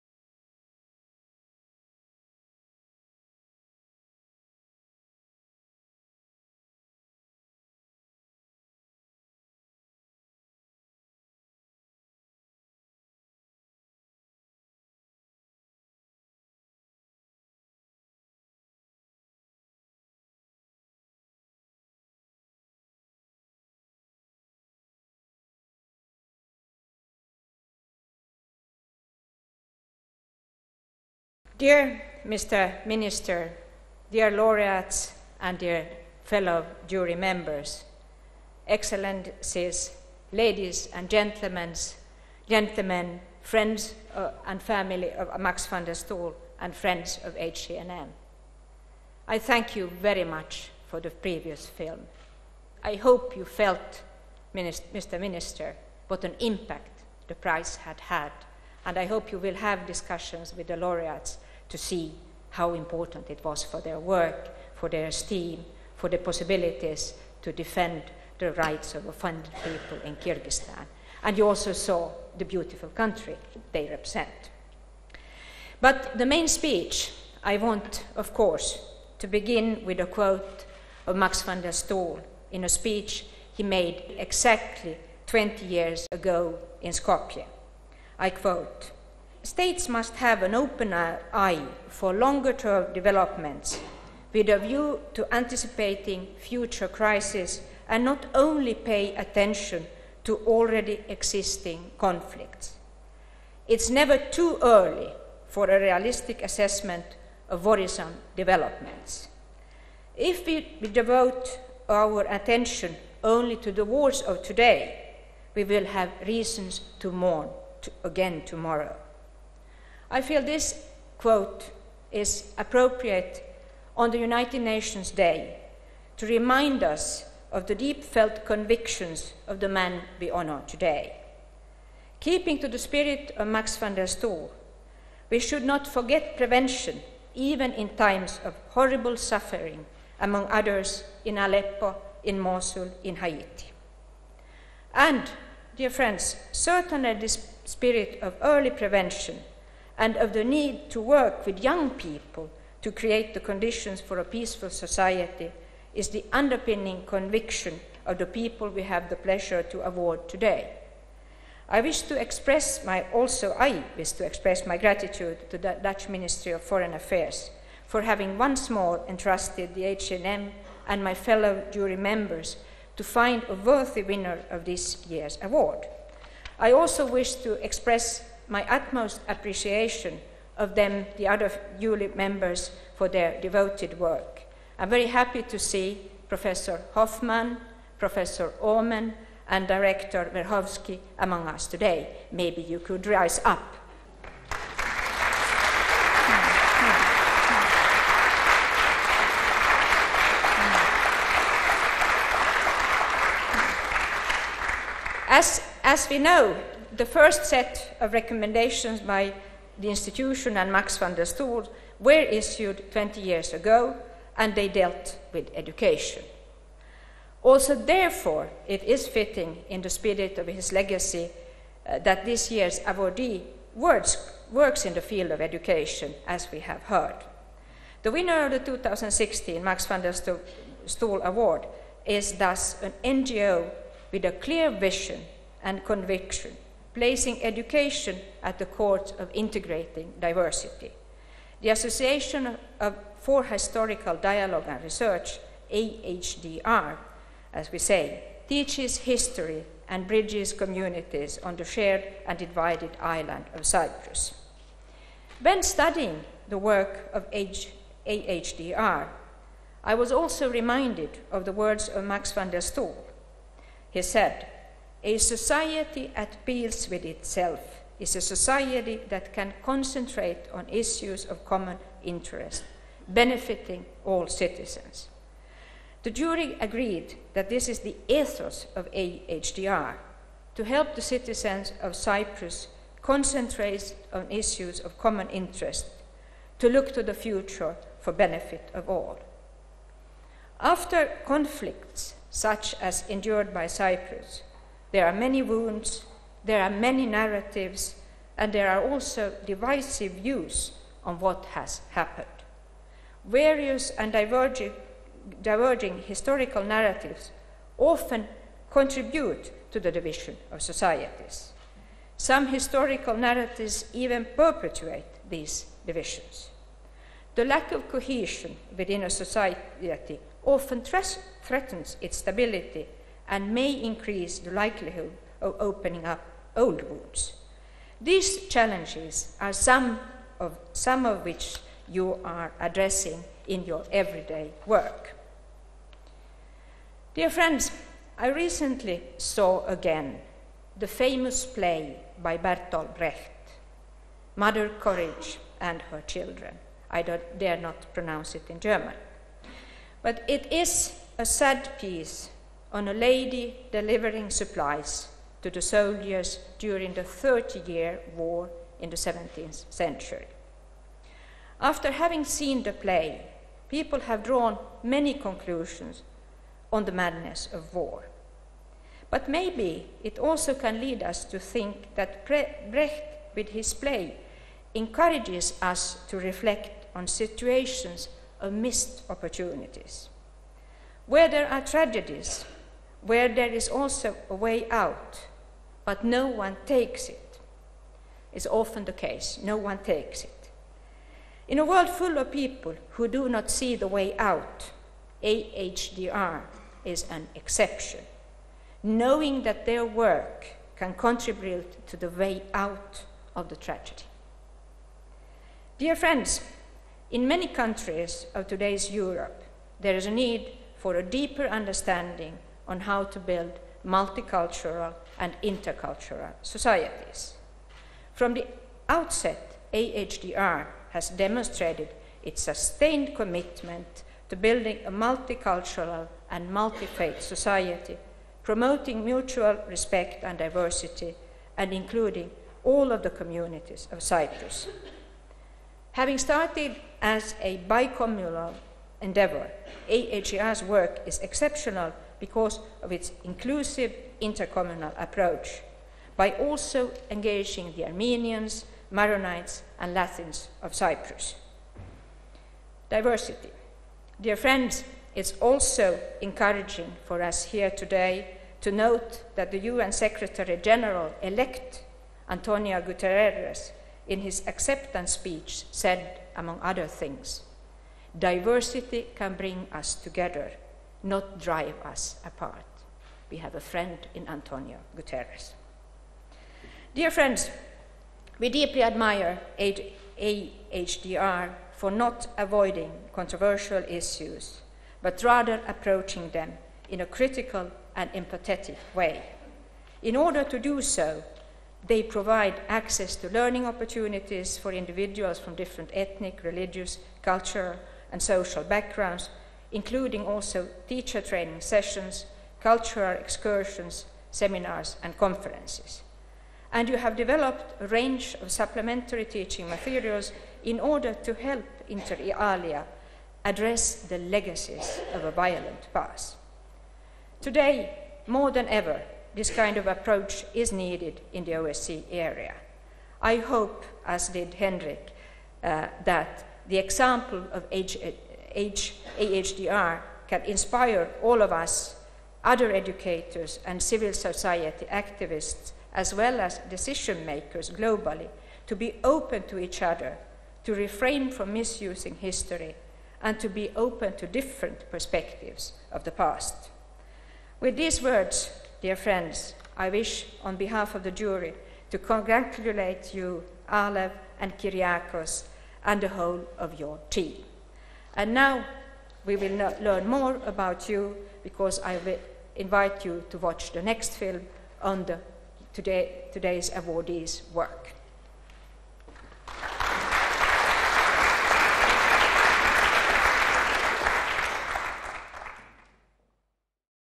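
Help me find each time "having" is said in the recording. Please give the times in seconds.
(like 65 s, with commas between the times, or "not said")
168 s, 361 s, 435 s.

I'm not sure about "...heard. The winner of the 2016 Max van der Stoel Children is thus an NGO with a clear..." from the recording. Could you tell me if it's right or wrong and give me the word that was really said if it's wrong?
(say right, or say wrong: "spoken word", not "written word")
wrong: "Award", not "Children".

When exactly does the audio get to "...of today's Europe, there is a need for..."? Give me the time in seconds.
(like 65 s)
408 s.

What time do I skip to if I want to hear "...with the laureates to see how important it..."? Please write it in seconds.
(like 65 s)
60 s.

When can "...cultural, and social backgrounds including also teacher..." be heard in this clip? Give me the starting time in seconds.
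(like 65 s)
497 s.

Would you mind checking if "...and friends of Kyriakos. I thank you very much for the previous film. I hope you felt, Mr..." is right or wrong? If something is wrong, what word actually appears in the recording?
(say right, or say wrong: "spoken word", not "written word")
wrong: "HCNM", not "Kyriakos".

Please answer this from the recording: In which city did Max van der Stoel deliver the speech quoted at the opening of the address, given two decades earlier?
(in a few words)
Skopje.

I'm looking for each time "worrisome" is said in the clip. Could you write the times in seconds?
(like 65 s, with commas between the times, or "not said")
107 s.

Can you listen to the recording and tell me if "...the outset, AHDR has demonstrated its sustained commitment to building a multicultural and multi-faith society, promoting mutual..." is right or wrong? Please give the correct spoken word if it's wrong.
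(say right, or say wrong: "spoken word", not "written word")
right.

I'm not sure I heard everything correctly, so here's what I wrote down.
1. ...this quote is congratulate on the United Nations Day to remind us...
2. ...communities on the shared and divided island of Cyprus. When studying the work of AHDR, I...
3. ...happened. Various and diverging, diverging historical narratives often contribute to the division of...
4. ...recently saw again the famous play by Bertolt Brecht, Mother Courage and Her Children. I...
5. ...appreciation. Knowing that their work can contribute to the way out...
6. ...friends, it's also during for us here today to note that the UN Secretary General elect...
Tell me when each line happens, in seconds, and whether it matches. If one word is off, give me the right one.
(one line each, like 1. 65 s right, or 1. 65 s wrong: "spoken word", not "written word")
1. 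120 s wrong: "appropriate", not "congratulate"
2. 250 s right
3. 301 s right
4. 338 s right
5. 397 s wrong: "exception", not "appreciation"
6. 454 s wrong: "encouraging", not "during".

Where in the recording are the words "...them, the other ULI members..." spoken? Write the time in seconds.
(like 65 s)
180 s.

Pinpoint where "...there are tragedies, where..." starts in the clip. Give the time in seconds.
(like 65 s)
381 s.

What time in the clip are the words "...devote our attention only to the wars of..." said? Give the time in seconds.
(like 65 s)
110 s.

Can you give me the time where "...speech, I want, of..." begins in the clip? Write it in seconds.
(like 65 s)
76 s.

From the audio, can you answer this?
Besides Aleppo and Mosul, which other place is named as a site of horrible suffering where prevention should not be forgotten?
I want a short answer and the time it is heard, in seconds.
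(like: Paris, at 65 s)
Haiti, at 143 s.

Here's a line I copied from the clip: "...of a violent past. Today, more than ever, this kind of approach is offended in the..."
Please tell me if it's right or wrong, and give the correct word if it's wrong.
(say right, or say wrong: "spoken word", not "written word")
wrong: "needed", not "offended".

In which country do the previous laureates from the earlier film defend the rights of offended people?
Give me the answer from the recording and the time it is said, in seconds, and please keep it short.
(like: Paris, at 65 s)
Kyrgyzstan, at 70 s.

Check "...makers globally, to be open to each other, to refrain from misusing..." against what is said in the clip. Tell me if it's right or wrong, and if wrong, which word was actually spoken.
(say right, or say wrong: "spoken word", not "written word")
right.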